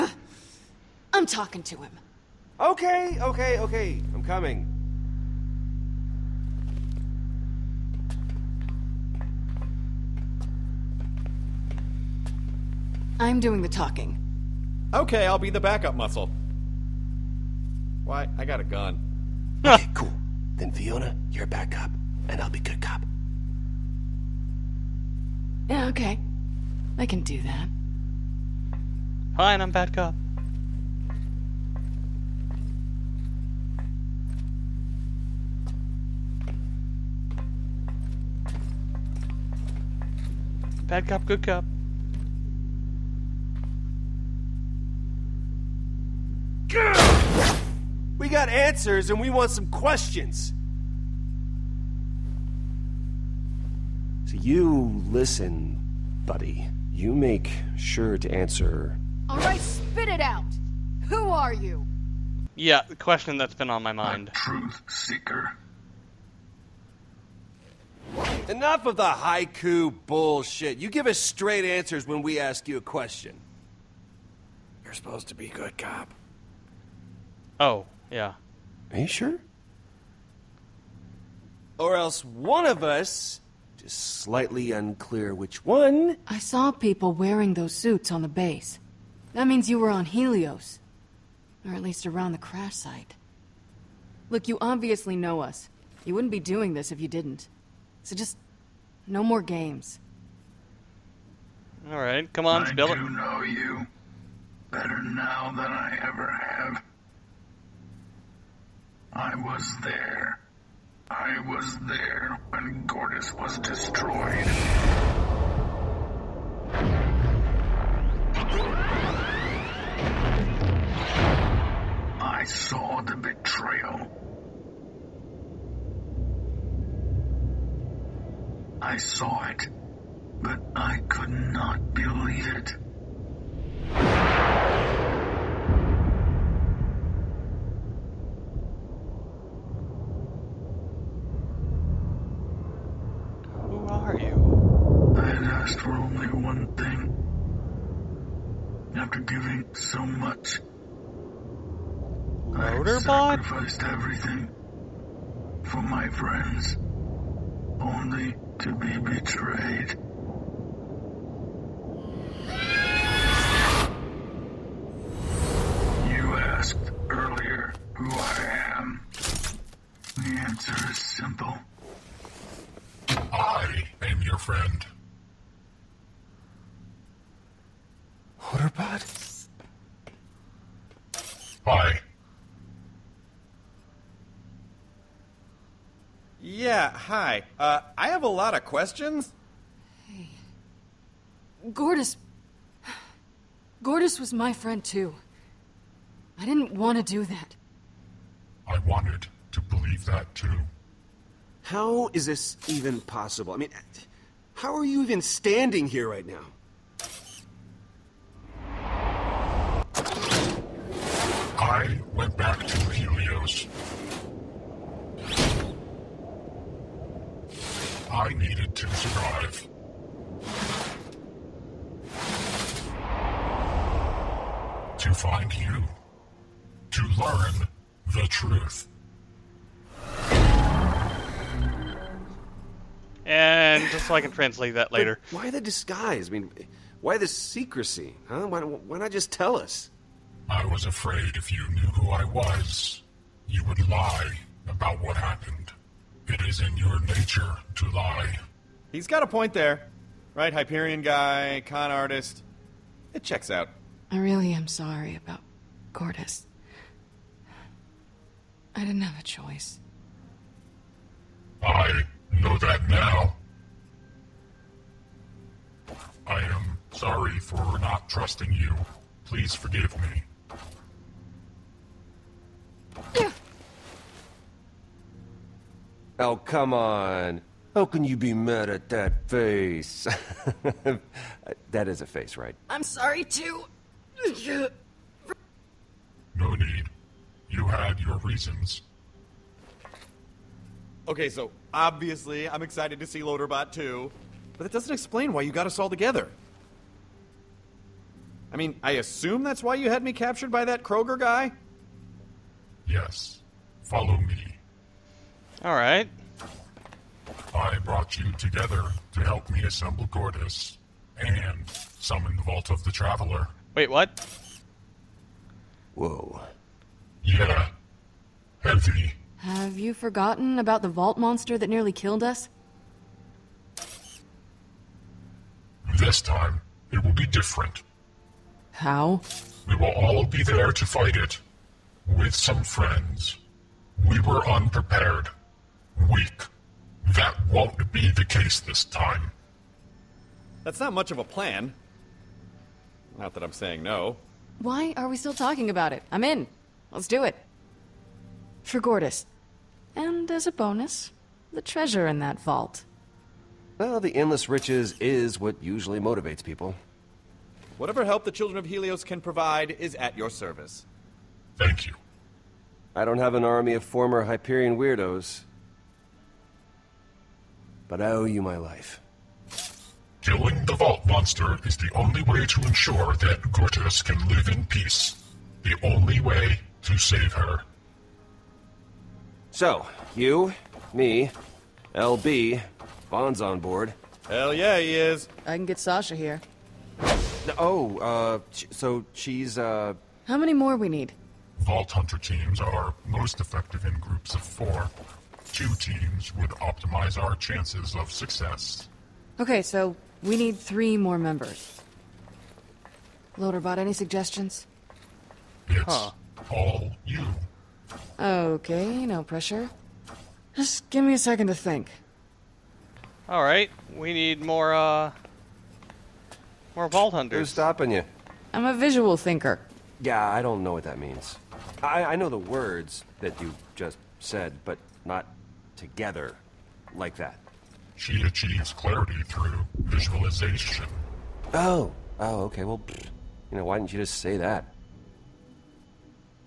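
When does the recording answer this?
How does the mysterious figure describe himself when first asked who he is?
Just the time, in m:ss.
1:04.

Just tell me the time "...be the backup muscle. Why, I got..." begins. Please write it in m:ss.
0:15.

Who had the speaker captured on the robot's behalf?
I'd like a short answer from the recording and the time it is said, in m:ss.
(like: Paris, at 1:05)
Kroger guy, at 5:00.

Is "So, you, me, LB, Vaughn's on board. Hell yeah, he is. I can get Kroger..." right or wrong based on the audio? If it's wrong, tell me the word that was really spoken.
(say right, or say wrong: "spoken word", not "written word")
wrong: "Sasha", not "Kroger".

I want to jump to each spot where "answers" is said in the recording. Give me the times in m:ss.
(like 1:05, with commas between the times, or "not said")
0:48, 0:58, 1:11.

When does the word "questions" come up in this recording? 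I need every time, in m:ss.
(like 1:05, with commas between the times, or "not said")
0:49, 1:02, 1:12, 3:08.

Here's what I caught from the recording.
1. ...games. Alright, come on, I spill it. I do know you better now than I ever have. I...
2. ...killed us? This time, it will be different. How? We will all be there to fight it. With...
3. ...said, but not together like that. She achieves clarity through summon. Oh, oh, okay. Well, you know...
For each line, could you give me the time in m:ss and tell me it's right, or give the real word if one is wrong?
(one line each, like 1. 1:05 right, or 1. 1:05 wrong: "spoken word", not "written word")
1. 1:39 right
2. 5:21 right
3. 7:04 wrong: "visualization", not "summon".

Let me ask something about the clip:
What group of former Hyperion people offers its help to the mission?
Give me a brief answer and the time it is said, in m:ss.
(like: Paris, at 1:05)
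Children of Helios, at 5:58.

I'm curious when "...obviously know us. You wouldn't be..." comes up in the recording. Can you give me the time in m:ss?
1:34.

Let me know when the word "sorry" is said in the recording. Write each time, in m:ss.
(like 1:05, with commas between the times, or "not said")
4:14, 4:26, 4:42.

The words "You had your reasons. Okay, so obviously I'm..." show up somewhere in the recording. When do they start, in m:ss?
4:47.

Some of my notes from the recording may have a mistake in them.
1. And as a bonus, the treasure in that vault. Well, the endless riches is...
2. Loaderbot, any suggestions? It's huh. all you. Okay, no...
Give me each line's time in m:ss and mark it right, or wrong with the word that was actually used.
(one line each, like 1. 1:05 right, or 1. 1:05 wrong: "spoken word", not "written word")
1. 5:49 right
2. 6:43 right.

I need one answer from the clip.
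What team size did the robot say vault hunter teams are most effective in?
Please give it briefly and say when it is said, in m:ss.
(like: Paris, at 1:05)
4, at 6:33.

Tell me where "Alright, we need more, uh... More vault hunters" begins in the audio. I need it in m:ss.
6:53.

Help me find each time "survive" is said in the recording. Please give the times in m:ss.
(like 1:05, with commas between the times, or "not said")
3:38.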